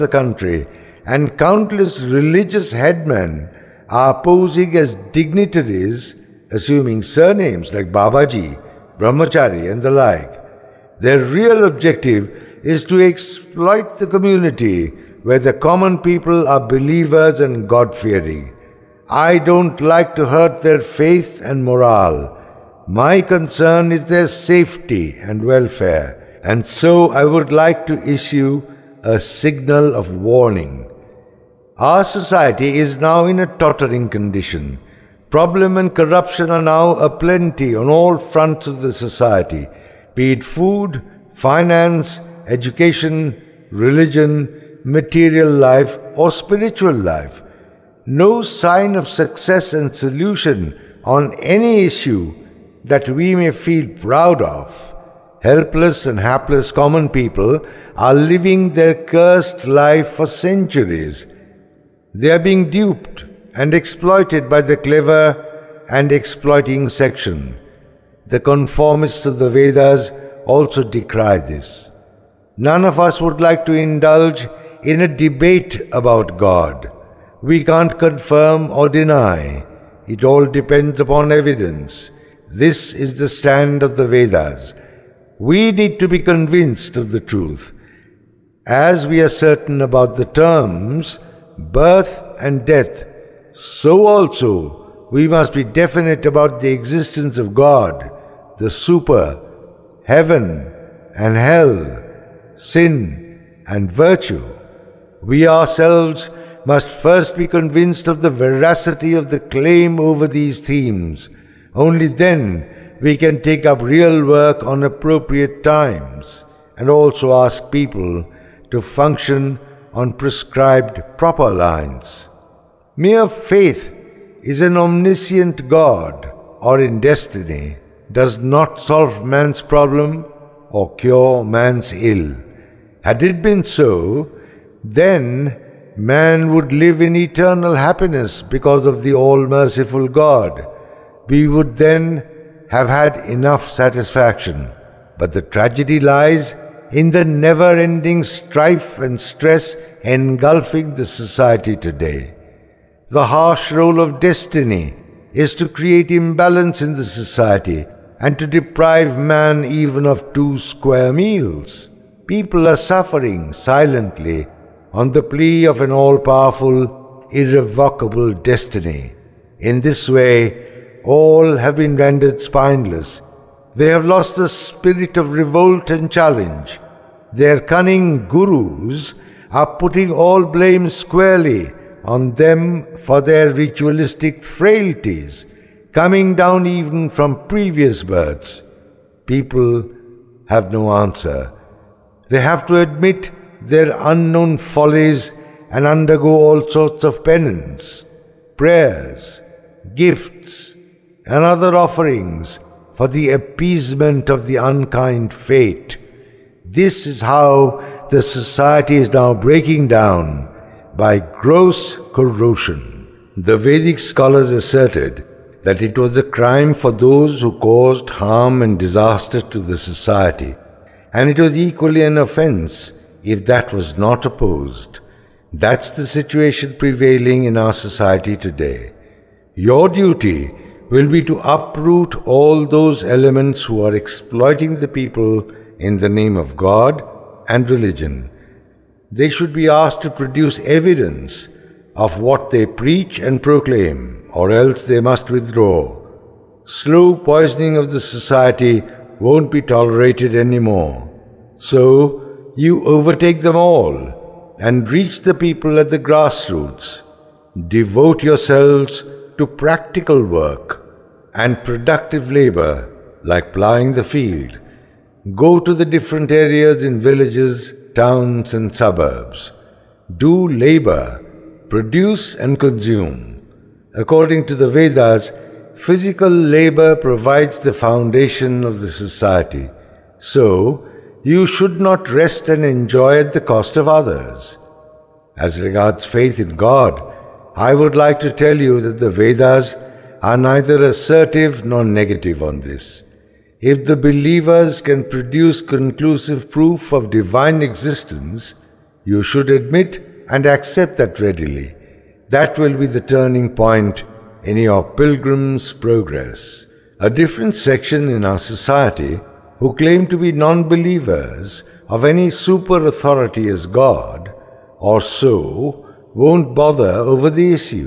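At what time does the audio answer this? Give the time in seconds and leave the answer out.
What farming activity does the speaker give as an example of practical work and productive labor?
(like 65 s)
263 s.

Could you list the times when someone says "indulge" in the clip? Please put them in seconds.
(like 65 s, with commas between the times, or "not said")
73 s.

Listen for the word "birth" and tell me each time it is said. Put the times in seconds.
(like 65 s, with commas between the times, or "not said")
91 s, 188 s.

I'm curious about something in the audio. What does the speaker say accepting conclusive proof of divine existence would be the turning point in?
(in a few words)
pilgrim's progress.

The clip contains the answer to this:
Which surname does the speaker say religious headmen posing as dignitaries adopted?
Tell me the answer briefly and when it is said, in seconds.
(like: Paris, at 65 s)
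Babaji, at 7 s.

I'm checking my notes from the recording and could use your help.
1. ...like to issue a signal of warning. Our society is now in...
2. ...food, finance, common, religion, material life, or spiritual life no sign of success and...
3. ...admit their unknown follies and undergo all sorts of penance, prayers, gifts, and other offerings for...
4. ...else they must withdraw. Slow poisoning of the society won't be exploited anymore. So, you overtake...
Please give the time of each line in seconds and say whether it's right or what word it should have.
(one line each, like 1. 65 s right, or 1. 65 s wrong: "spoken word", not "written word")
1. 27 s right
2. 40 s wrong: "education", not "common"
3. 192 s right
4. 244 s wrong: "tolerated", not "exploited".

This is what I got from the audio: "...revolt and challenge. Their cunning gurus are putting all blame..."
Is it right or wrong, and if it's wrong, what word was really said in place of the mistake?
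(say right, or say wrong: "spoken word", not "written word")
right.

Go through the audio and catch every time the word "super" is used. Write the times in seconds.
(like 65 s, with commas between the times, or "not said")
98 s, 312 s.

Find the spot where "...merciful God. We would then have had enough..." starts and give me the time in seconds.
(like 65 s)
139 s.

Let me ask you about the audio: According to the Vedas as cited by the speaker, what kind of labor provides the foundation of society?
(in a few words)
physical labor.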